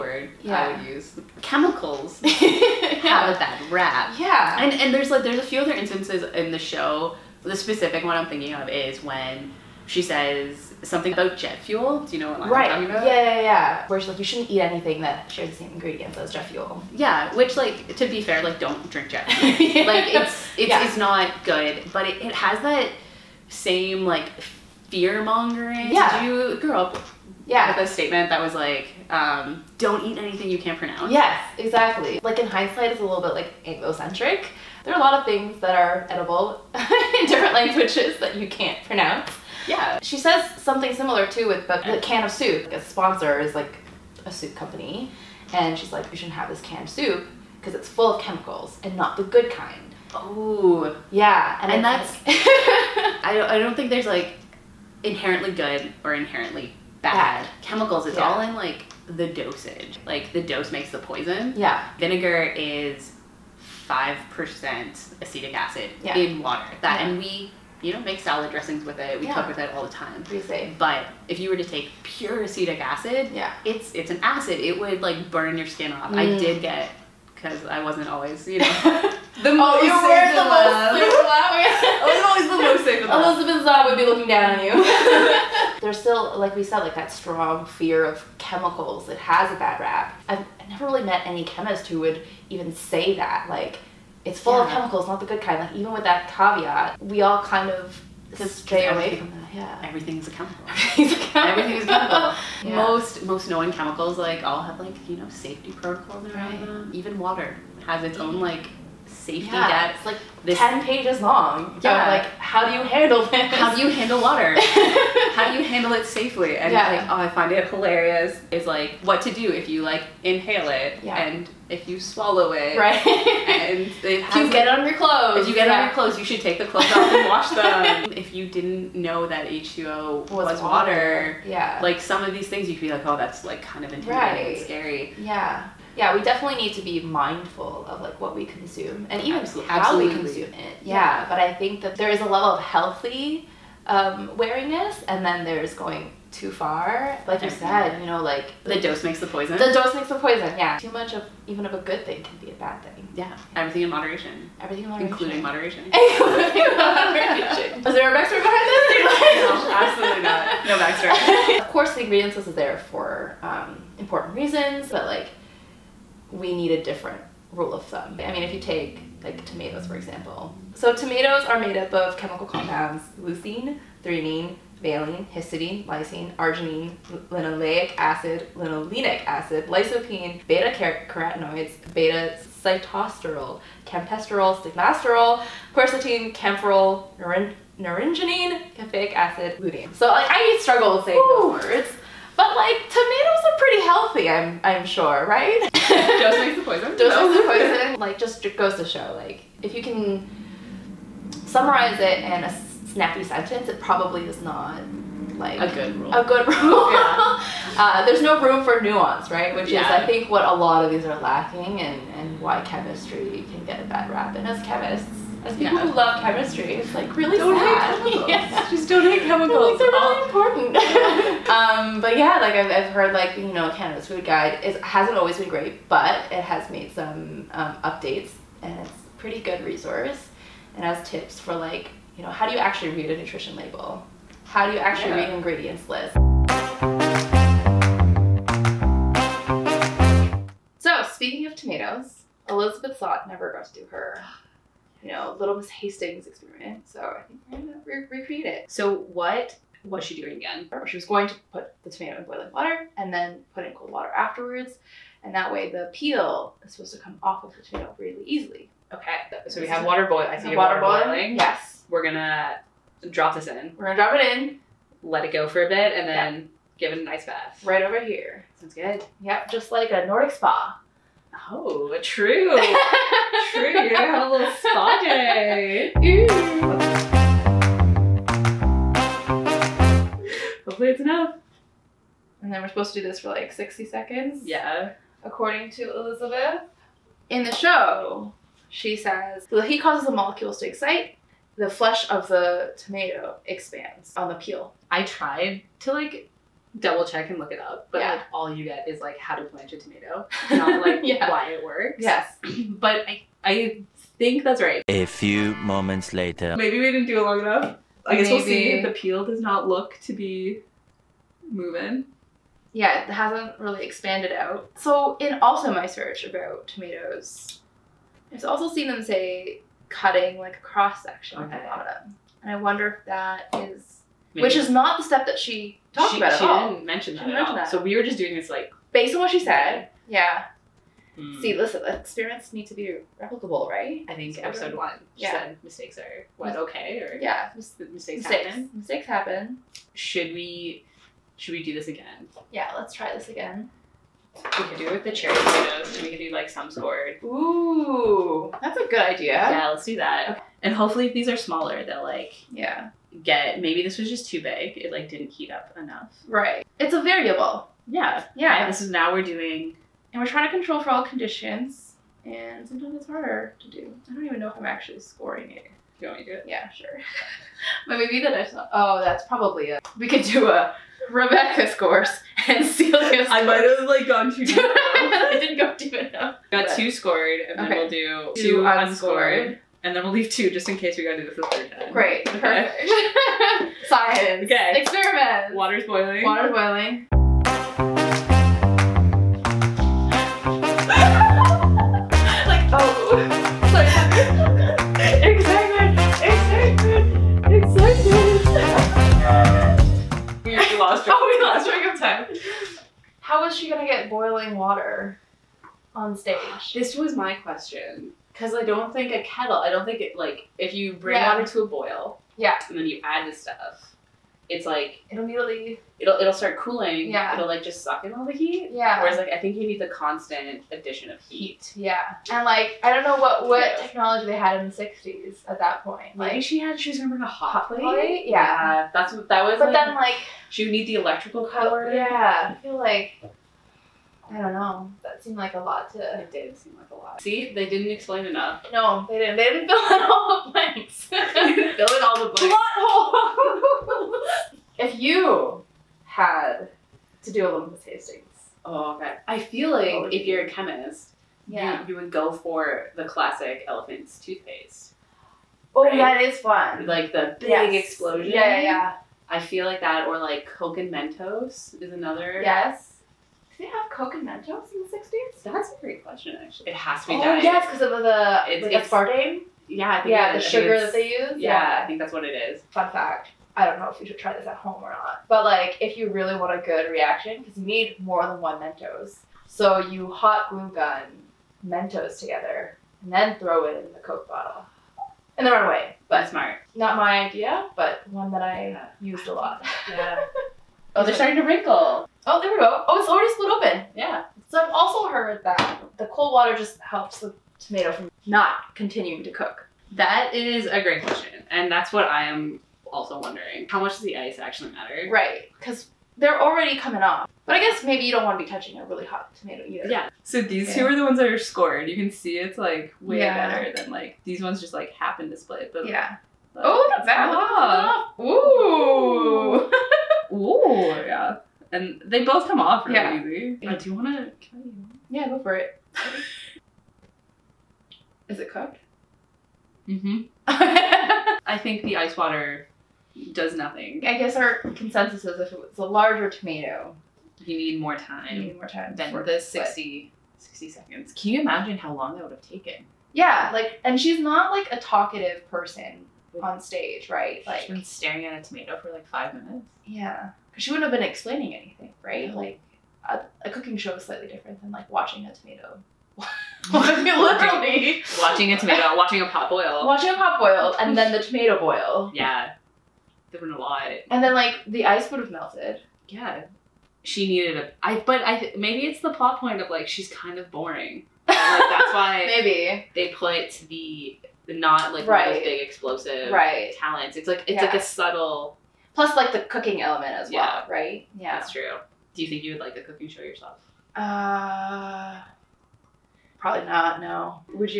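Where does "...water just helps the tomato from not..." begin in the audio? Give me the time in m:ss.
8:16.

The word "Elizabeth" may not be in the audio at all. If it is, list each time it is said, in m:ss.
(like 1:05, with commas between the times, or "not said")
1:23, 4:02, 4:45.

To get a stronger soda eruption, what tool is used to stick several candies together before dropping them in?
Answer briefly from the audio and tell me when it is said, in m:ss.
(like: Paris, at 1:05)
hot glue gun, at 8:00.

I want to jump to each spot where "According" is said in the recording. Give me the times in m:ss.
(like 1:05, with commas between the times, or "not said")
4:45.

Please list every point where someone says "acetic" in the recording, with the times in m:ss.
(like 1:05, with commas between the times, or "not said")
1:05, 1:12.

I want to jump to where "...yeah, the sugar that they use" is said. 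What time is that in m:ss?
7:50.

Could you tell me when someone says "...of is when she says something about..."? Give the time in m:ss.
0:08.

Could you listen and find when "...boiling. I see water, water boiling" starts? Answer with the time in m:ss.
4:20.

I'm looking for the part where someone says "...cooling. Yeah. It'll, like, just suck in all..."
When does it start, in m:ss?
6:56.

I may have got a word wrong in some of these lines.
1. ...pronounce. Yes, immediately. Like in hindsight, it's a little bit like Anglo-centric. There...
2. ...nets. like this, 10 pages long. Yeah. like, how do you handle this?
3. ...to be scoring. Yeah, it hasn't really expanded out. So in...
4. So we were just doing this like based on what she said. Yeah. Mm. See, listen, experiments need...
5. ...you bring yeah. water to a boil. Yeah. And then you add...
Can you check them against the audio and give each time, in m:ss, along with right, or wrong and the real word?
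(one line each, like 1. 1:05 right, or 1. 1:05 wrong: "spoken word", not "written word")
1. 0:30 wrong: "exactly", not "immediately"
2. 1:49 right
3. 5:10 wrong: "moving", not "scoring"
4. 5:27 right
5. 6:50 right.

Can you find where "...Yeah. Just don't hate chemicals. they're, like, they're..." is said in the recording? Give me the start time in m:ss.
3:38.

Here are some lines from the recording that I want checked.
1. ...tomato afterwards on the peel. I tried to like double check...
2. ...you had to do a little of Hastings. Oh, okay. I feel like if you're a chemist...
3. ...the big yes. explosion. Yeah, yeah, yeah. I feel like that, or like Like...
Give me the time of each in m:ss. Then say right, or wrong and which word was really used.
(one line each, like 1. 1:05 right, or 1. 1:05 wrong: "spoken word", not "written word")
1. 4:52 wrong: "expands", not "afterwards"
2. 7:24 right
3. 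7:37 wrong: "Coke", not "Like".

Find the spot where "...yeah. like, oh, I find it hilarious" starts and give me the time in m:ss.
1:56.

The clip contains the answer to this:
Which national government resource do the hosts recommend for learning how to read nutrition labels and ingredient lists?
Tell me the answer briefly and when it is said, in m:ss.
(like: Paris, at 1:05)
Canada's food guide, at 3:43.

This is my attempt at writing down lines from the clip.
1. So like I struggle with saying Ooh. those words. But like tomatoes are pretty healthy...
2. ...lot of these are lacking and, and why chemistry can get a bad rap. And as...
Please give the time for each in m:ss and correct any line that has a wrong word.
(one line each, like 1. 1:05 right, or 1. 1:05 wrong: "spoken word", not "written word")
1. 3:09 right
2. 3:30 right.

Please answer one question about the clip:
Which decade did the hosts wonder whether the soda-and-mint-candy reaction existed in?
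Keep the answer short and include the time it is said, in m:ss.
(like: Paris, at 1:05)
the sixties, at 7:44.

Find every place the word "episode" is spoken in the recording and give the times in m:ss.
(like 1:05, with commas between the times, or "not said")
5:34.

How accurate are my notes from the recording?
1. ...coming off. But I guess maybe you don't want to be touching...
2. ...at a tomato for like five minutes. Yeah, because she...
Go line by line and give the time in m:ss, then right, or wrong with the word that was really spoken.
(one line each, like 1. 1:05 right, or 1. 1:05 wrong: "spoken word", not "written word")
1. 8:26 right
2. 9:08 right.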